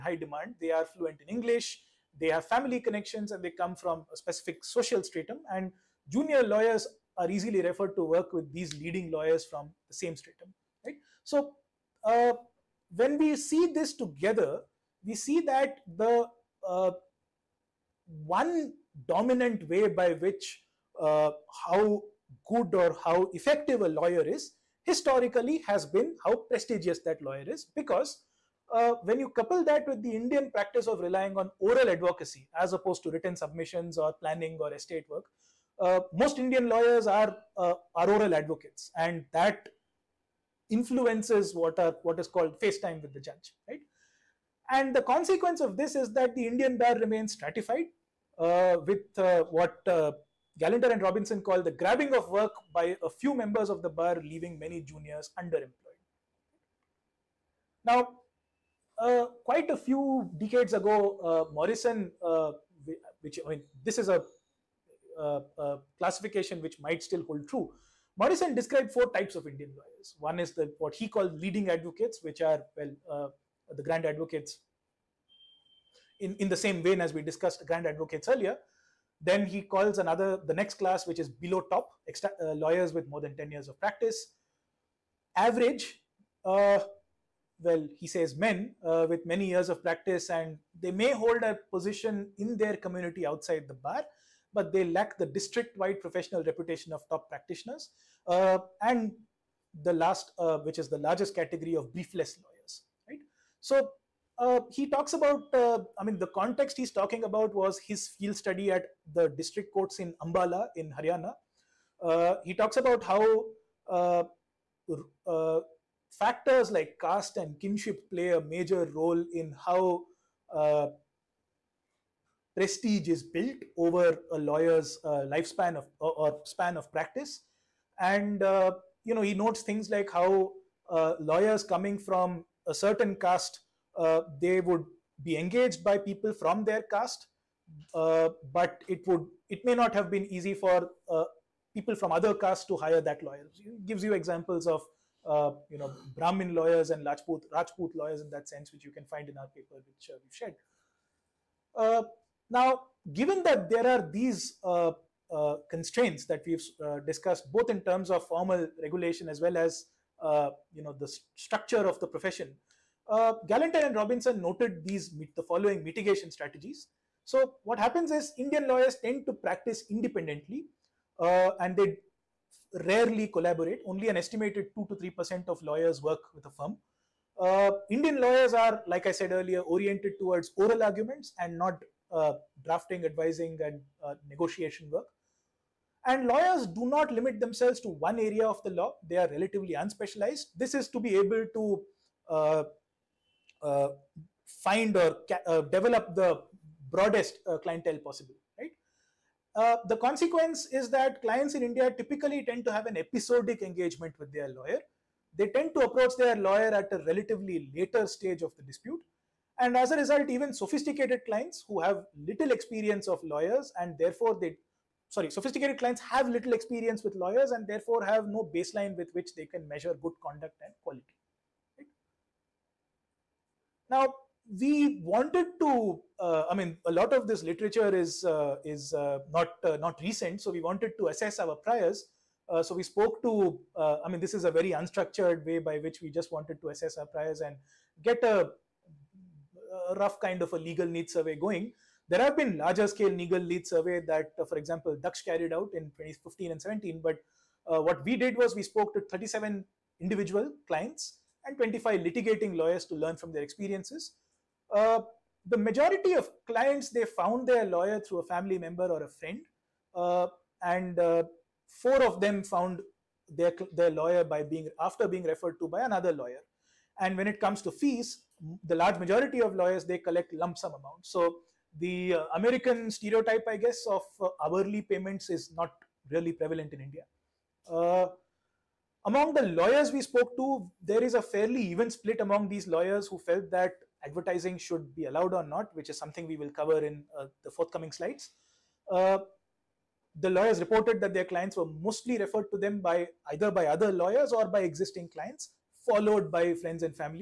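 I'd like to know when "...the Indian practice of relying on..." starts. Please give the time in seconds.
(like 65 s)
30 s.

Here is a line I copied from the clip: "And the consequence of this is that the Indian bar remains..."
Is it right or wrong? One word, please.
right.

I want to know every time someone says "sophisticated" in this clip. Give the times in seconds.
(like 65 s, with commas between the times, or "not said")
210 s, 215 s.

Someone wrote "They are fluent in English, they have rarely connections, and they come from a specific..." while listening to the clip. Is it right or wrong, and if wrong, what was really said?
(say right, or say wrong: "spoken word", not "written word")
wrong: "family", not "rarely".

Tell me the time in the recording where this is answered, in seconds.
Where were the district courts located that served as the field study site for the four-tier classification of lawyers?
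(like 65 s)
110 s.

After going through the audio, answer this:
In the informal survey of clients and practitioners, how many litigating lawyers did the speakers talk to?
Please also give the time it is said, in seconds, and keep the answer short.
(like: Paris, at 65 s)
25, at 251 s.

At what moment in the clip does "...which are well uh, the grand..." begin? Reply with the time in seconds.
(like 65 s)
72 s.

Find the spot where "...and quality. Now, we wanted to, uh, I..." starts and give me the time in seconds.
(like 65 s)
220 s.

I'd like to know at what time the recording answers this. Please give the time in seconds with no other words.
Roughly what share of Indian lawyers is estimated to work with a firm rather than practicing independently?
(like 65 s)
174 s.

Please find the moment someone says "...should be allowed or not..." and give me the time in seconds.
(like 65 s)
284 s.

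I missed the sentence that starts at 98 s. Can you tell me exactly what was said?
Uh, and the last, uh, which is the largest category of briefless lawyers, right?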